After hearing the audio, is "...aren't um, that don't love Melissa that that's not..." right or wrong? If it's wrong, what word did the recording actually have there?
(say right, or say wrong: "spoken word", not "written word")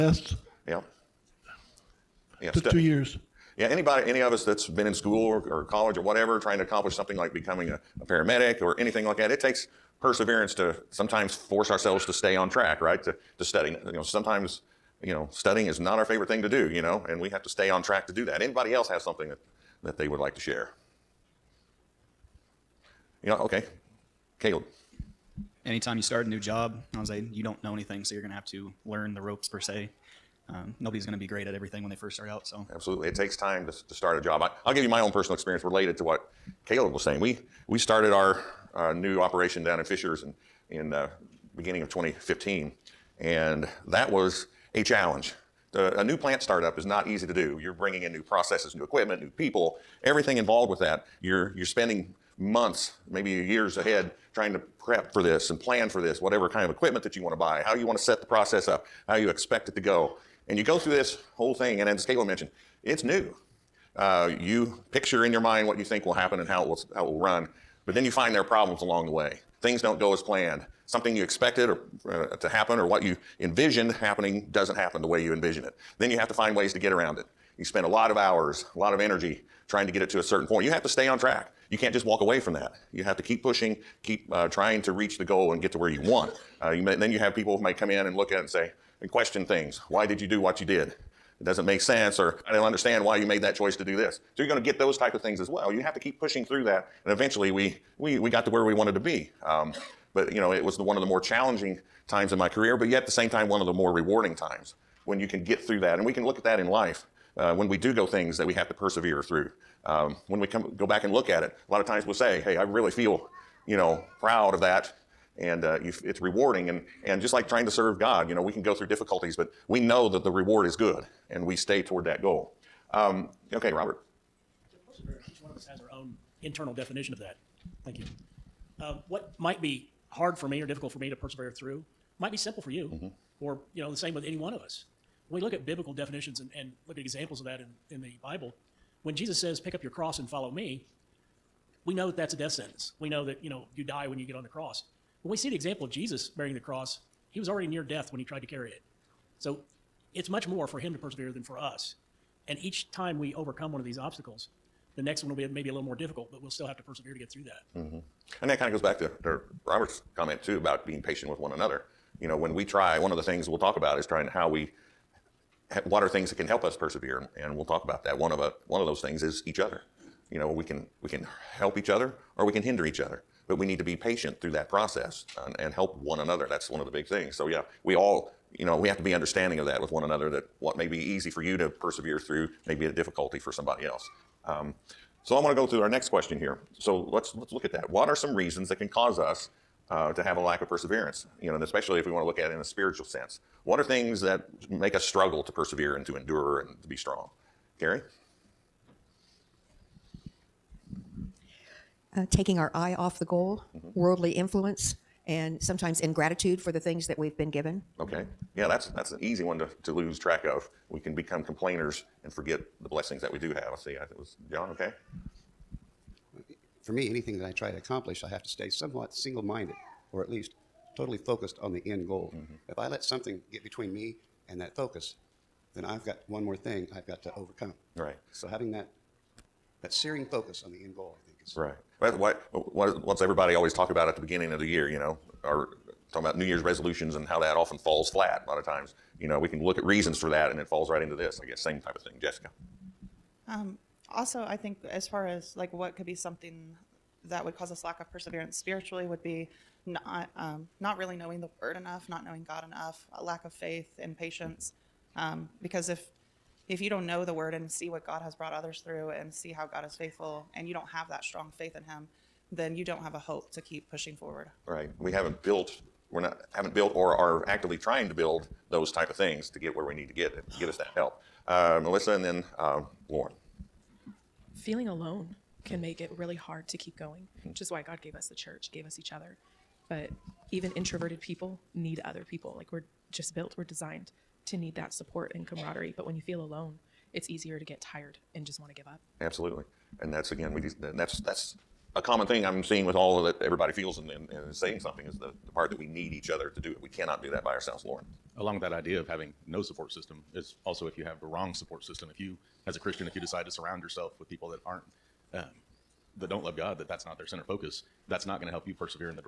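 wrong: "God", not "Melissa".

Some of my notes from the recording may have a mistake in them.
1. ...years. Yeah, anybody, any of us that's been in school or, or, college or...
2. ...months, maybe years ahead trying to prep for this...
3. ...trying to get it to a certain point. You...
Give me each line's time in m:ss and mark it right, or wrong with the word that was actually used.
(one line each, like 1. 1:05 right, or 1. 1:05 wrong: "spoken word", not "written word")
1. 0:02 right
2. 0:52 right
3. 1:19 right.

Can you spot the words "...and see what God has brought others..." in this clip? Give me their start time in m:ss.
4:17.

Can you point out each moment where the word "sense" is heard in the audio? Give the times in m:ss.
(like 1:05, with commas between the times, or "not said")
1:31, 3:13.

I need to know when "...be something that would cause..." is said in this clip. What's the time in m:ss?
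4:06.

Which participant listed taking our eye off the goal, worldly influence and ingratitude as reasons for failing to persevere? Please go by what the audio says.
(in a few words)
Carrie.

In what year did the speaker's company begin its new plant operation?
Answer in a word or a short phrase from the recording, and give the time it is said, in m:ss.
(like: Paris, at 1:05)
2015, at 0:41.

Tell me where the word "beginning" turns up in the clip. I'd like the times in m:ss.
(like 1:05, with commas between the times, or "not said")
0:41, 3:54.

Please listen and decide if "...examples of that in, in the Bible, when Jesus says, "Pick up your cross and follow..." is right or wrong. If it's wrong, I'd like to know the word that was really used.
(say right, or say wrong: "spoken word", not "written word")
right.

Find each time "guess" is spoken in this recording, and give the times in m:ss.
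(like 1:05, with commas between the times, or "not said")
4:01.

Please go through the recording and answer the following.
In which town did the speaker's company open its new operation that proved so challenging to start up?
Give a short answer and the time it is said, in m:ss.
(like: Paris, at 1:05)
Fishers, at 0:39.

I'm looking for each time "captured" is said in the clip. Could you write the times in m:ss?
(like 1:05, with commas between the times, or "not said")
not said.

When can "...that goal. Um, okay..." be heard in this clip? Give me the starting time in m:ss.
2:02.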